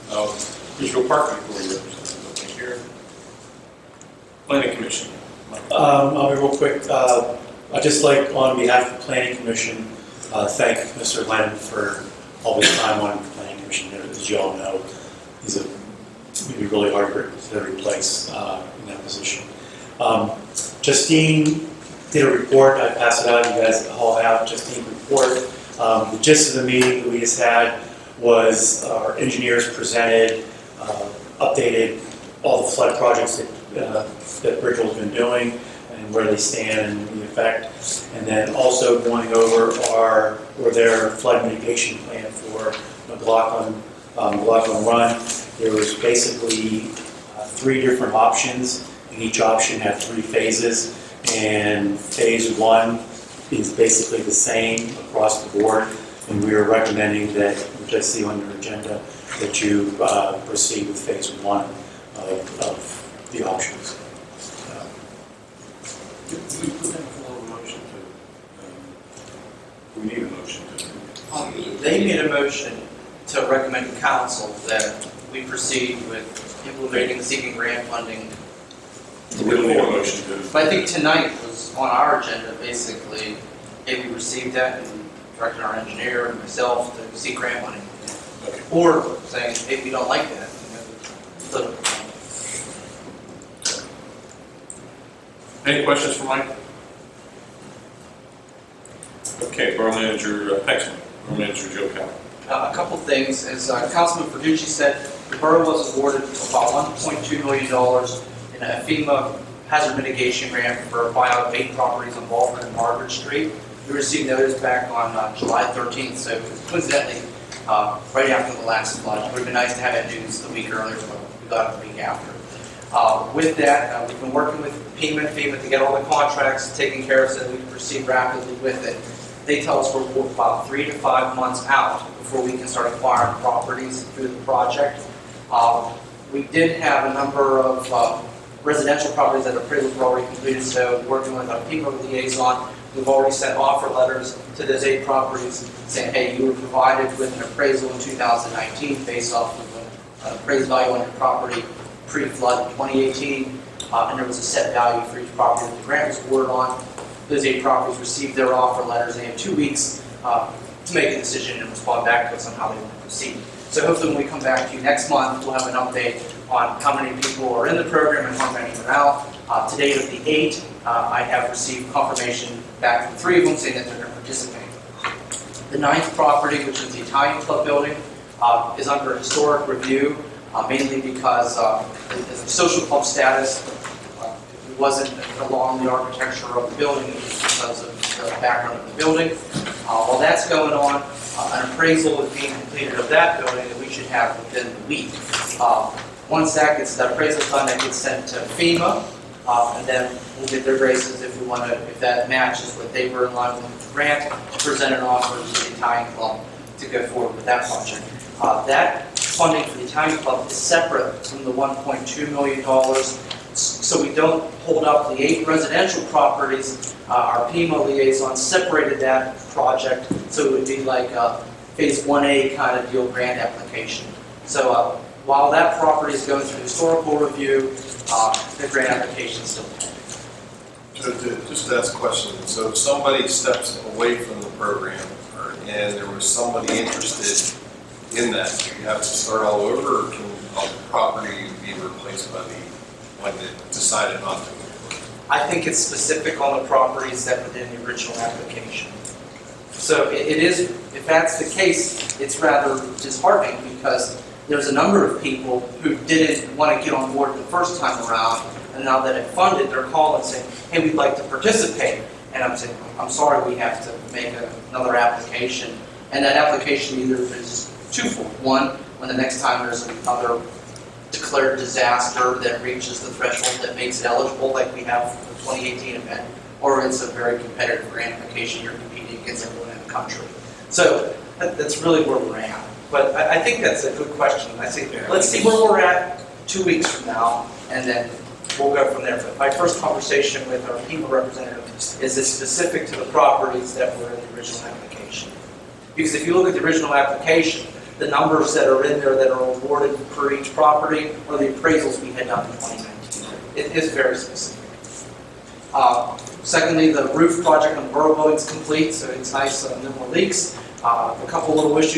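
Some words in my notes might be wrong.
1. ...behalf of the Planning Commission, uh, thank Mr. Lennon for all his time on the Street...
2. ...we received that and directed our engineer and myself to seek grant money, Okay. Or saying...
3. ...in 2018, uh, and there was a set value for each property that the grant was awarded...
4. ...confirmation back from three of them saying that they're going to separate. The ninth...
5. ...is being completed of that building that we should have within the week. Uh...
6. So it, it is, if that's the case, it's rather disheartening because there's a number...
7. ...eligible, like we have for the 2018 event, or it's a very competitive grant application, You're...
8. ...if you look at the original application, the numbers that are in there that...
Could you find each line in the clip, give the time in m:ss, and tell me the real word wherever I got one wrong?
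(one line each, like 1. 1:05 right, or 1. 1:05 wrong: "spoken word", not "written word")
1. 0:08 wrong: "Planning", not "Street"
2. 1:24 right
3. 2:32 right
4. 2:51 wrong: "participate", not "separate"
5. 3:12 right
6. 4:09 right
7. 4:34 right
8. 4:56 right.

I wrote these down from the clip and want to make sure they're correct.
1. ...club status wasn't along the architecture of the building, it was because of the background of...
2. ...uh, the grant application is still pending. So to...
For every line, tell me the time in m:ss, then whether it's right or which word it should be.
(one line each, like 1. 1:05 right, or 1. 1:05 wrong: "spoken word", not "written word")
1. 3:02 right
2. 3:48 right.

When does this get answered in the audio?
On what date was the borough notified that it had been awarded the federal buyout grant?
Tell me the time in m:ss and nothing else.
1:55.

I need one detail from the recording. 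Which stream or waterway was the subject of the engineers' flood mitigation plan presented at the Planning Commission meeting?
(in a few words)
McLaughlin Run.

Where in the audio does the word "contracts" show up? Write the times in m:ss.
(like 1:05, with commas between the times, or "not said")
2:06.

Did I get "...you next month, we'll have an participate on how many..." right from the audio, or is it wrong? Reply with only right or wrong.
wrong.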